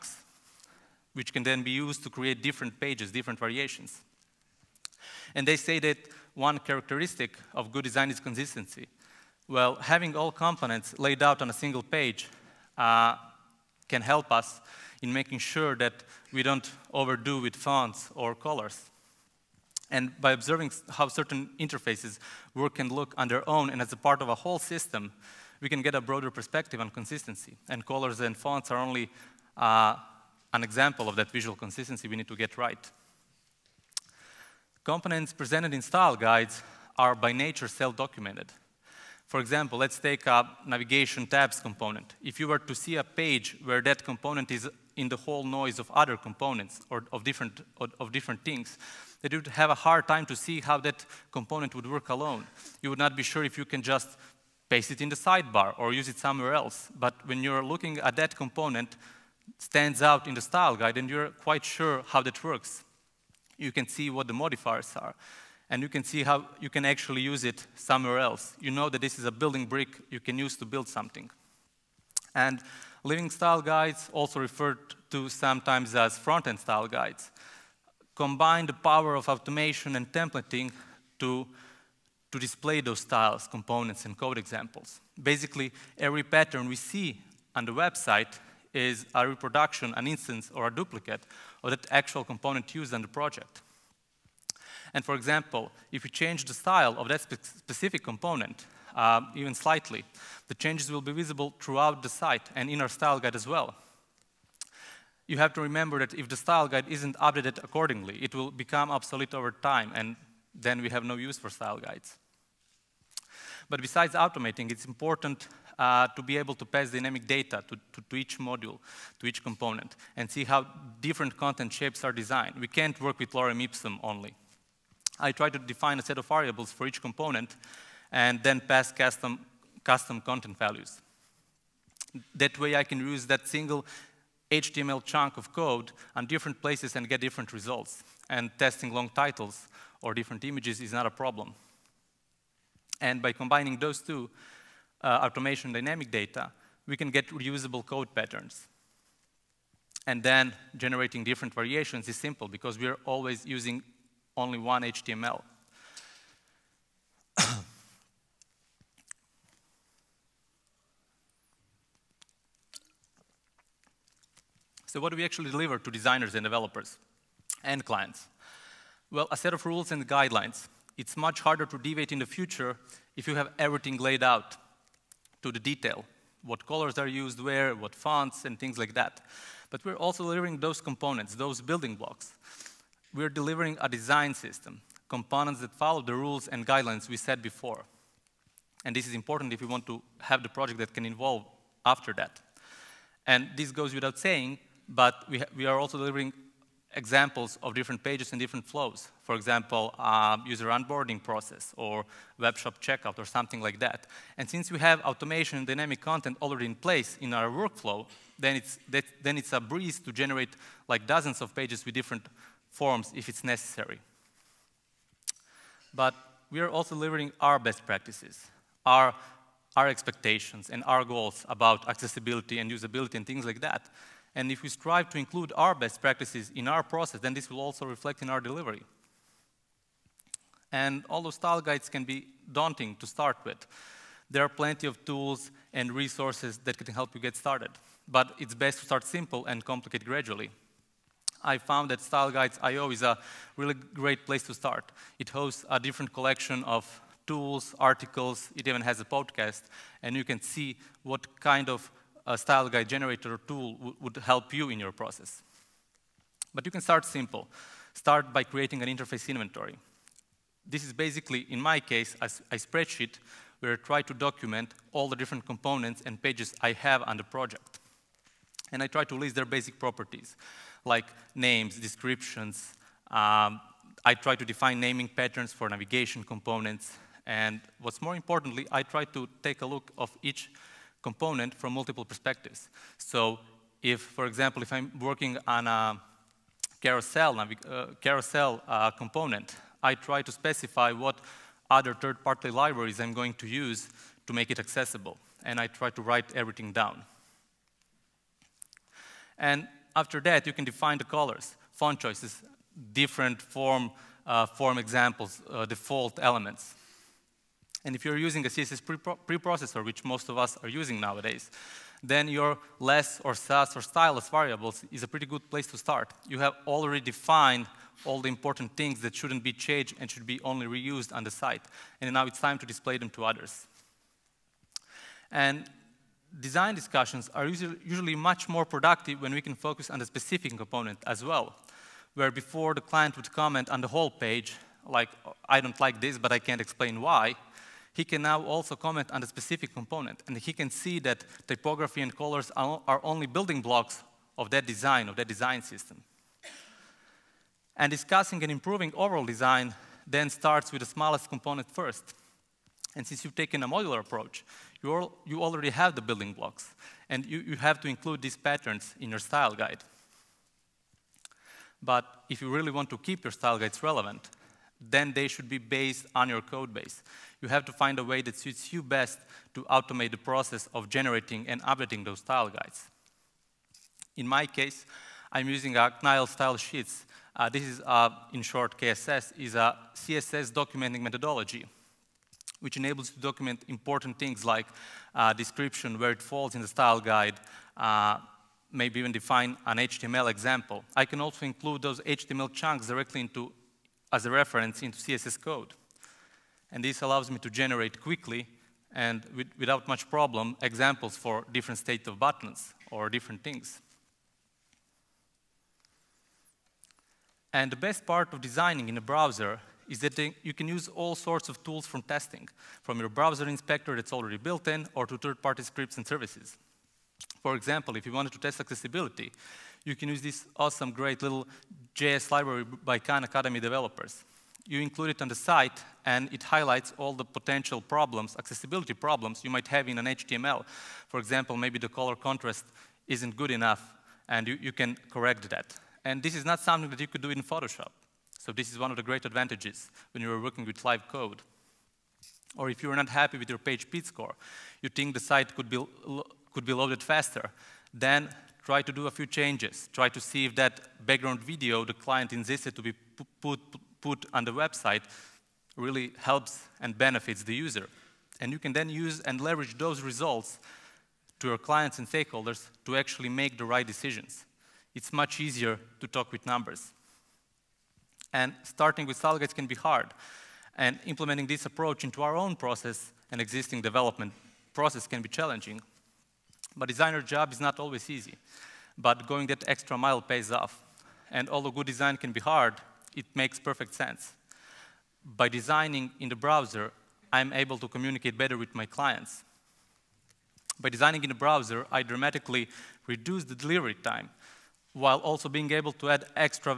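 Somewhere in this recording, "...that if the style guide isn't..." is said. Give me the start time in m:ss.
1:45.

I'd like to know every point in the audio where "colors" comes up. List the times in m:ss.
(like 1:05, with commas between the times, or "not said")
0:18, 0:27, 2:56, 5:01, 5:42, 7:11.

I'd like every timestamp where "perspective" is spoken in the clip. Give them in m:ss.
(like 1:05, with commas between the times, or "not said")
0:26, 4:42.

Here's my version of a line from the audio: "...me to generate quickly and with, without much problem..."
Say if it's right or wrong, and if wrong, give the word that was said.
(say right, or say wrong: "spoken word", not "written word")
right.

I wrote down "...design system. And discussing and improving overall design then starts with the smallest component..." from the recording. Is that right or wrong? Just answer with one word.
right.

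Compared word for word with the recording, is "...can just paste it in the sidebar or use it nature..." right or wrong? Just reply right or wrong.
wrong.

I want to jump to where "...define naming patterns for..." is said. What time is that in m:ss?
4:34.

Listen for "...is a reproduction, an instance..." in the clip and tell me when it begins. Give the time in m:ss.
1:28.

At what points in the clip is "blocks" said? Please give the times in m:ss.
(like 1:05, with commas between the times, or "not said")
3:01, 5:43, 5:56.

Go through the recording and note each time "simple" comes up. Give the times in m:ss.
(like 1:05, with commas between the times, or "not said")
2:32, 3:59, 4:17.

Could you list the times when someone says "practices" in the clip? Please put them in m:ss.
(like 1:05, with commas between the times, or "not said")
3:37, 3:46.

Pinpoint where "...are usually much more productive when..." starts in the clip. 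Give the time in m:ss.
5:27.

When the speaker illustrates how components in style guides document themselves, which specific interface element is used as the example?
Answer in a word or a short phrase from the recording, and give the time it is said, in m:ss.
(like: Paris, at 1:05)
navigation tabs, at 0:40.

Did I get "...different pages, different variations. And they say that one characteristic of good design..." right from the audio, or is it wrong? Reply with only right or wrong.
right.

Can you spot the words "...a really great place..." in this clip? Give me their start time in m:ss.
4:03.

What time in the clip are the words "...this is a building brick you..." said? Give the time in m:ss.
1:09.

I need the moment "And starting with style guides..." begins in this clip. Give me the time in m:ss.
7:48.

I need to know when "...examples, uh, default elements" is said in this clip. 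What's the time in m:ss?
5:04.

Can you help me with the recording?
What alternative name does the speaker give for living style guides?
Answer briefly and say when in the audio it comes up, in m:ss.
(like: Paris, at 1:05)
front-end style guides, at 1:16.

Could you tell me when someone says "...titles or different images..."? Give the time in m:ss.
2:19.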